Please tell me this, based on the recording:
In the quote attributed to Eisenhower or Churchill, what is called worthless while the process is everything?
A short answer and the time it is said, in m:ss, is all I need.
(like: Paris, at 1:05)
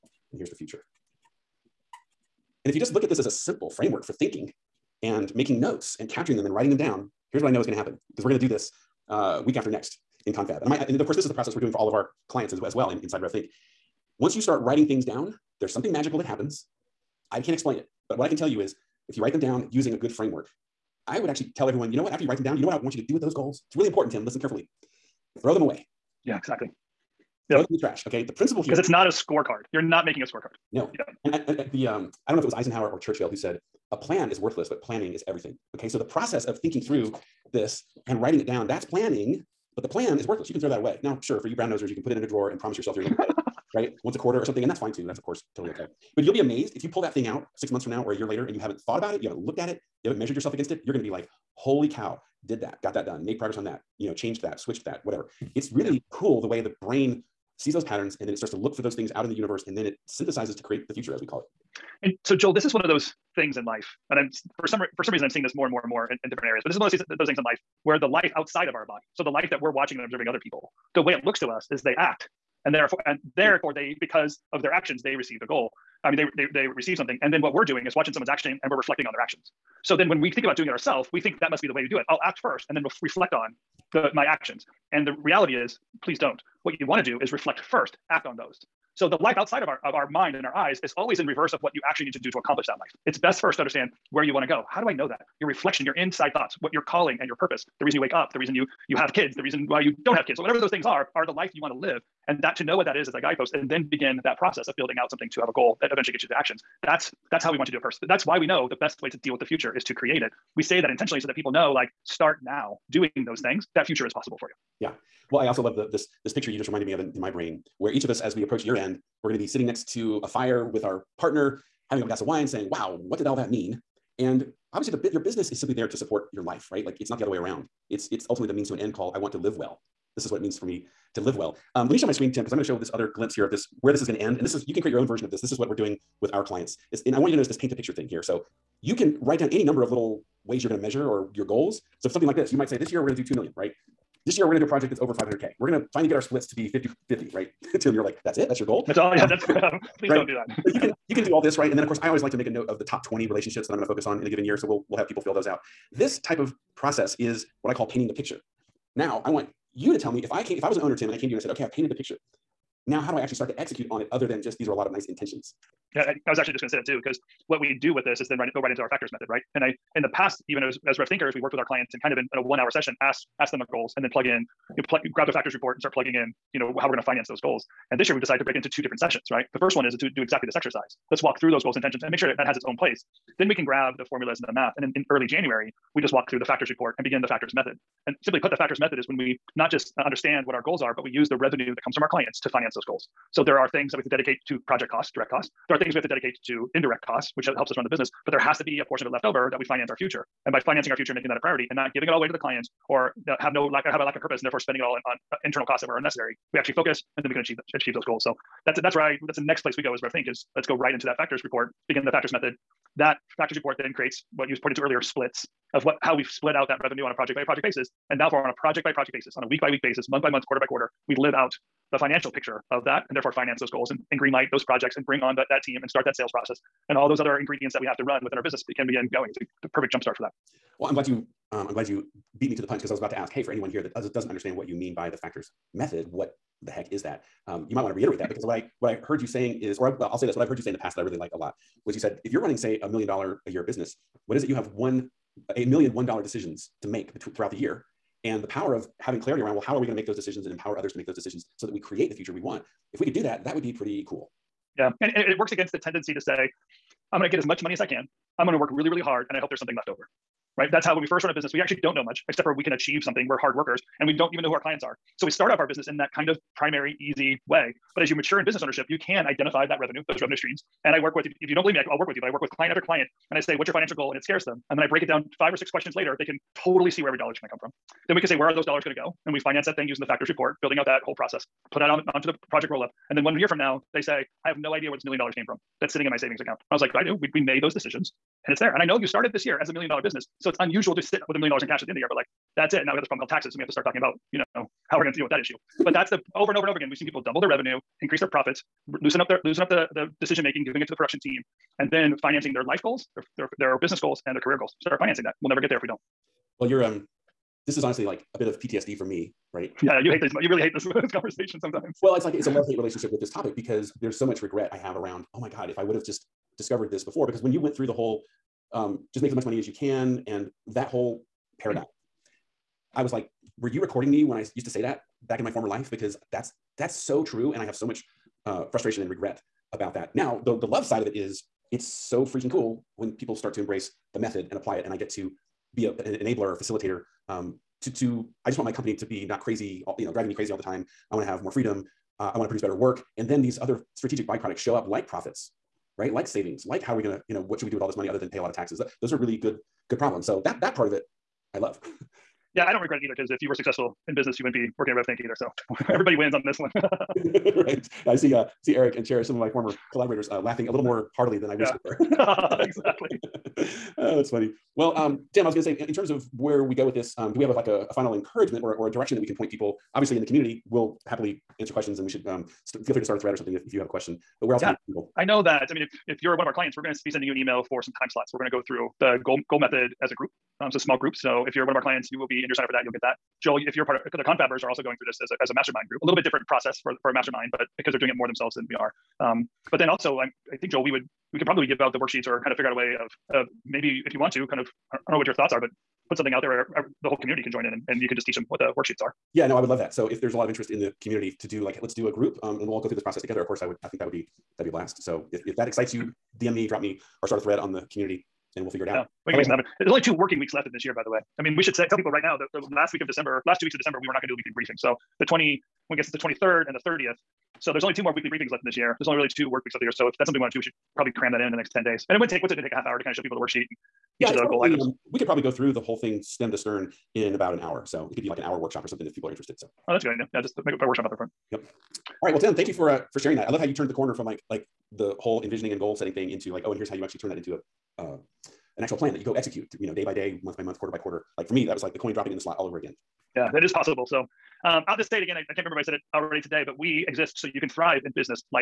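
a plan, at 0:33.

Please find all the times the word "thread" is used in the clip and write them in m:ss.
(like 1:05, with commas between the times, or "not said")
6:13, 6:47.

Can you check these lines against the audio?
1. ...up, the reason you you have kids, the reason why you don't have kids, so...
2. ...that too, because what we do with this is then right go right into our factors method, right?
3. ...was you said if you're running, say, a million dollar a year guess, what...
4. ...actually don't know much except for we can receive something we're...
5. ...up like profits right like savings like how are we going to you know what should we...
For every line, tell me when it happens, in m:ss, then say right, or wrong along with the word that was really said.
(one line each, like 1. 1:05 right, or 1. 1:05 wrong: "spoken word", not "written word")
1. 1:38 right
2. 2:46 right
3. 4:01 wrong: "business", not "guess"
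4. 4:21 wrong: "achieve", not "receive"
5. 5:44 right.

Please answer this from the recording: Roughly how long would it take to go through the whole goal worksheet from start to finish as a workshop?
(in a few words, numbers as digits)
about an hour.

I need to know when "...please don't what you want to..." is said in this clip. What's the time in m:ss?
1:26.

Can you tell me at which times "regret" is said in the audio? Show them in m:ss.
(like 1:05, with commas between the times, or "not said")
5:14, 5:29, 5:52.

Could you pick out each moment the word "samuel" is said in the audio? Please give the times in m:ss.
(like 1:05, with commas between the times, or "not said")
not said.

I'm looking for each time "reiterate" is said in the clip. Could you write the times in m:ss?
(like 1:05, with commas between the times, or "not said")
3:57.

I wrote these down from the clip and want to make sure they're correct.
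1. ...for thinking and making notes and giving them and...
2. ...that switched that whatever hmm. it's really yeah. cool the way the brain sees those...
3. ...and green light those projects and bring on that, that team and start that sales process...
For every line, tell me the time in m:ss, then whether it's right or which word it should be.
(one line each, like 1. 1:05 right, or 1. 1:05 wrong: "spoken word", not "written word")
1. 0:04 wrong: "capturing", not "giving"
2. 0:54 right
3. 3:44 right.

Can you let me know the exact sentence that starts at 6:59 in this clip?
There's only really two work weeks left here.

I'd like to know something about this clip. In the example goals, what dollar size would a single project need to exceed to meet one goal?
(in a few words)
500K.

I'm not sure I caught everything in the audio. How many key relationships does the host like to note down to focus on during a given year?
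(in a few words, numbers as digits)
20.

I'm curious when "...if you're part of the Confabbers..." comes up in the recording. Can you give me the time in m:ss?
6:23.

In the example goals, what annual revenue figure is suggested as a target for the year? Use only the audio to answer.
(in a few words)
2 million.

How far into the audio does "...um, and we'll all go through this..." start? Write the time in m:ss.
6:42.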